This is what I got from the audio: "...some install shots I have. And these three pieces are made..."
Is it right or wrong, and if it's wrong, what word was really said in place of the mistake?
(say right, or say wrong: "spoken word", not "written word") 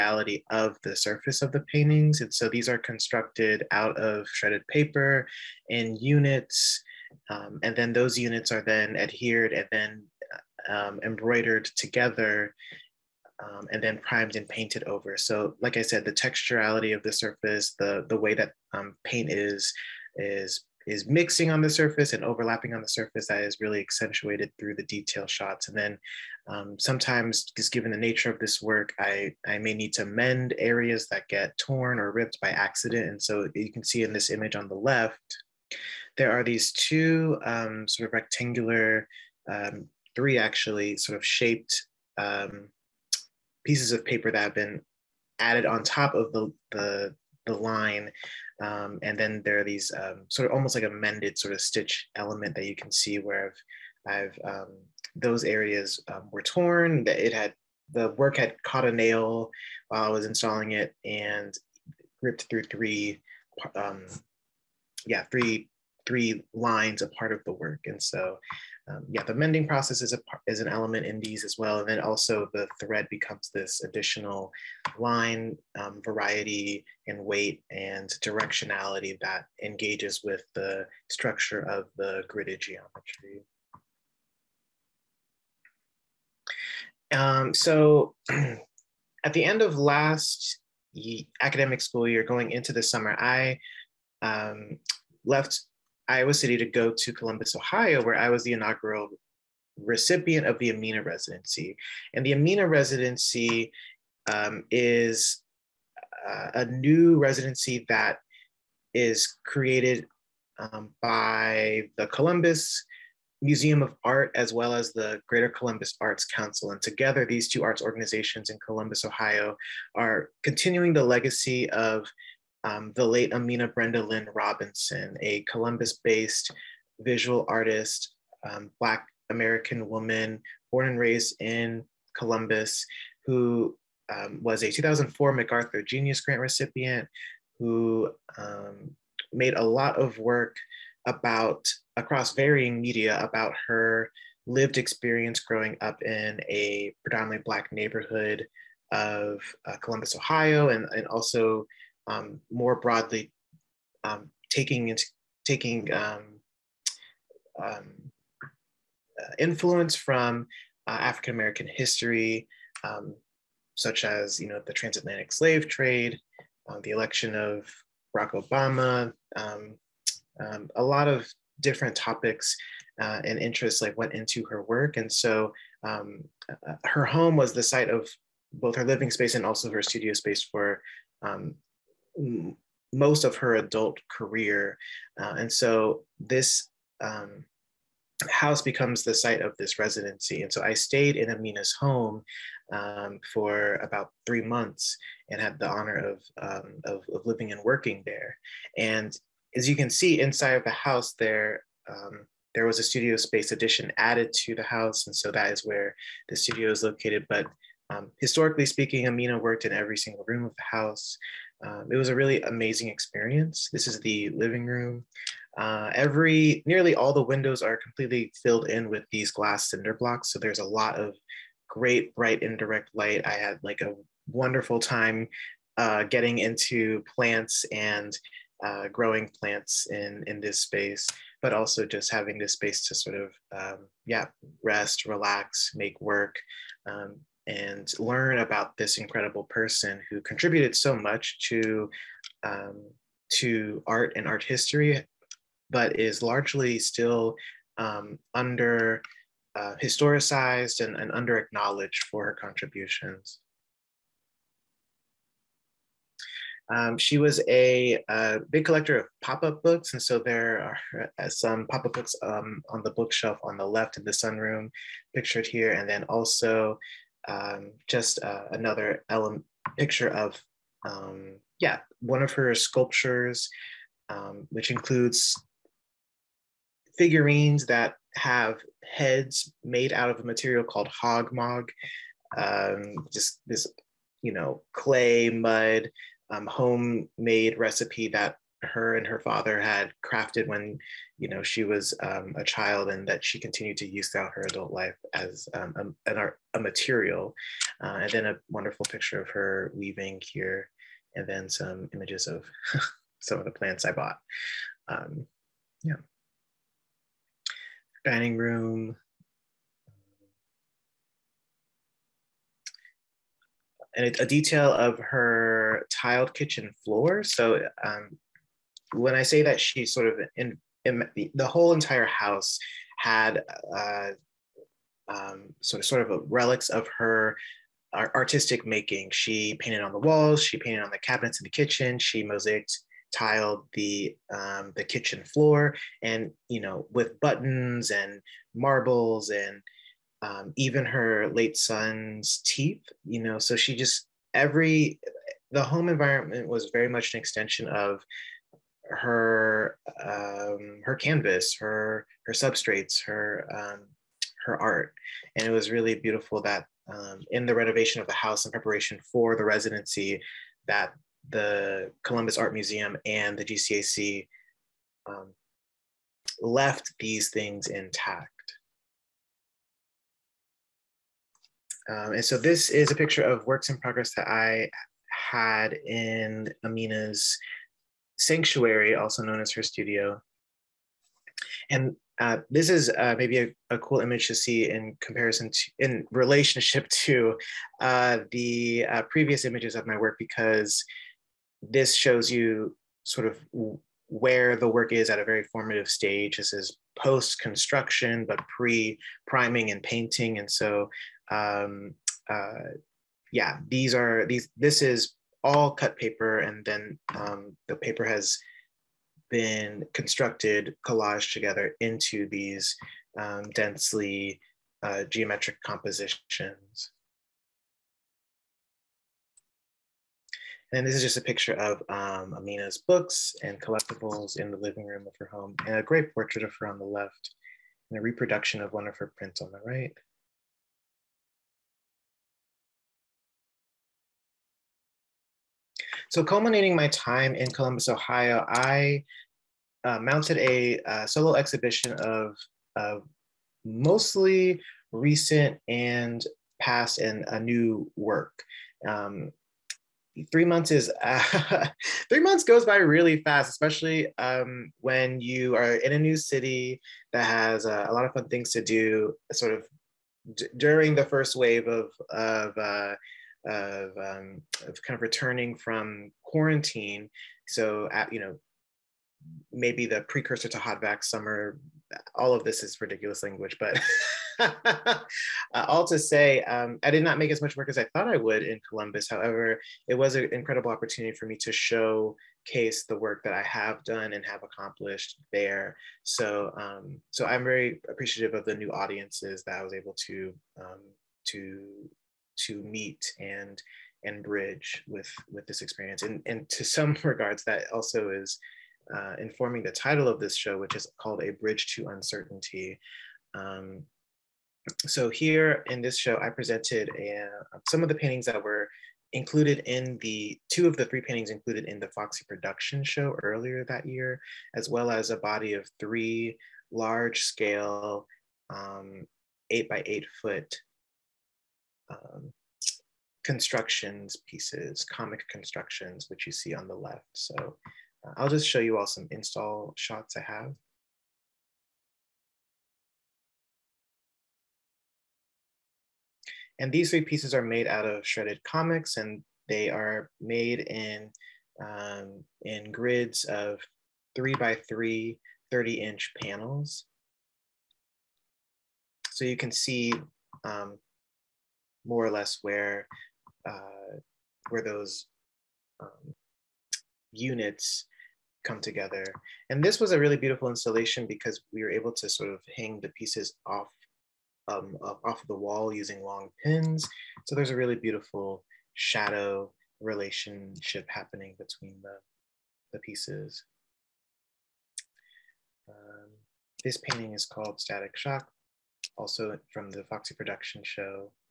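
right.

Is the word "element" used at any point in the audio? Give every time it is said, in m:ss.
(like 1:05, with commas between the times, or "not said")
0:52, 1:10, 4:29.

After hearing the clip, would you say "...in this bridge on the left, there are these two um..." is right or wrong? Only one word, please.
wrong.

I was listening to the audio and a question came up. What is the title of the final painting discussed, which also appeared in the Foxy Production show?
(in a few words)
Static Shock.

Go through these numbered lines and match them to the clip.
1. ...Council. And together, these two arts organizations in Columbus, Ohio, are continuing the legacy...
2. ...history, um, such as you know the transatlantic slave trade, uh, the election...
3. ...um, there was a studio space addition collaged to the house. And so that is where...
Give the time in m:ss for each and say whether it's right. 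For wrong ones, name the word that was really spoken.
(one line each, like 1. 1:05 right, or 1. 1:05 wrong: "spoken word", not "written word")
1. 1:56 right
2. 2:41 right
3. 3:21 wrong: "added", not "collaged".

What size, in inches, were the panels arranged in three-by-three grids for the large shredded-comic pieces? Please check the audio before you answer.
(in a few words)
30 inches.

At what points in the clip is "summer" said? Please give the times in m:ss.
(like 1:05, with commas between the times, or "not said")
1:32, 7:51.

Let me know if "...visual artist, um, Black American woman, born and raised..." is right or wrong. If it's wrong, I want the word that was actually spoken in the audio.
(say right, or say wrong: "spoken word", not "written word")
right.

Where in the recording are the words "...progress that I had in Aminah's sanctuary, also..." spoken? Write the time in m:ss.
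6:13.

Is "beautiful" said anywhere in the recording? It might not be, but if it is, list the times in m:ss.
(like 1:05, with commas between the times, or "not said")
5:55, 9:20, 9:27.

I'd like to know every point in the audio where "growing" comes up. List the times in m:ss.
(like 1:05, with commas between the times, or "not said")
2:25, 3:48.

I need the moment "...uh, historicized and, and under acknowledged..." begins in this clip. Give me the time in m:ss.
4:09.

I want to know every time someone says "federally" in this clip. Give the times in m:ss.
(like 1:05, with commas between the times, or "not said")
not said.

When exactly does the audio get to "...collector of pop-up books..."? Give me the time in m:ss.
4:18.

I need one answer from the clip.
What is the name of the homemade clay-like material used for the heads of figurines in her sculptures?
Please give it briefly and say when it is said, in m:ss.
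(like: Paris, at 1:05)
Hogmog, at 4:40.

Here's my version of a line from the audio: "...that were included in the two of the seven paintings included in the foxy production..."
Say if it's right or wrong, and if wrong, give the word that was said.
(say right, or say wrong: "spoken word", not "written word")
wrong: "three", not "seven".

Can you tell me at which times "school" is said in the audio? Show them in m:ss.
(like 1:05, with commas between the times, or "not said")
1:31.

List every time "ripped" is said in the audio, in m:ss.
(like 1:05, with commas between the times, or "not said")
0:32, 1:02.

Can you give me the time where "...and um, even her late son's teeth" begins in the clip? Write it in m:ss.
5:39.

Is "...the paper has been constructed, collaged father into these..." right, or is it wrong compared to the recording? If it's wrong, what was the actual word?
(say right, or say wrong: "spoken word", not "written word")
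wrong: "together", not "father".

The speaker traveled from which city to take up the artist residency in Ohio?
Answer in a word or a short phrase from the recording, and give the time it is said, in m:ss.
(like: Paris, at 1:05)
Iowa City, at 1:36.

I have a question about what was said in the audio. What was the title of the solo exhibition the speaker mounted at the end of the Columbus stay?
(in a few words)
A Bridge to Uncertainty.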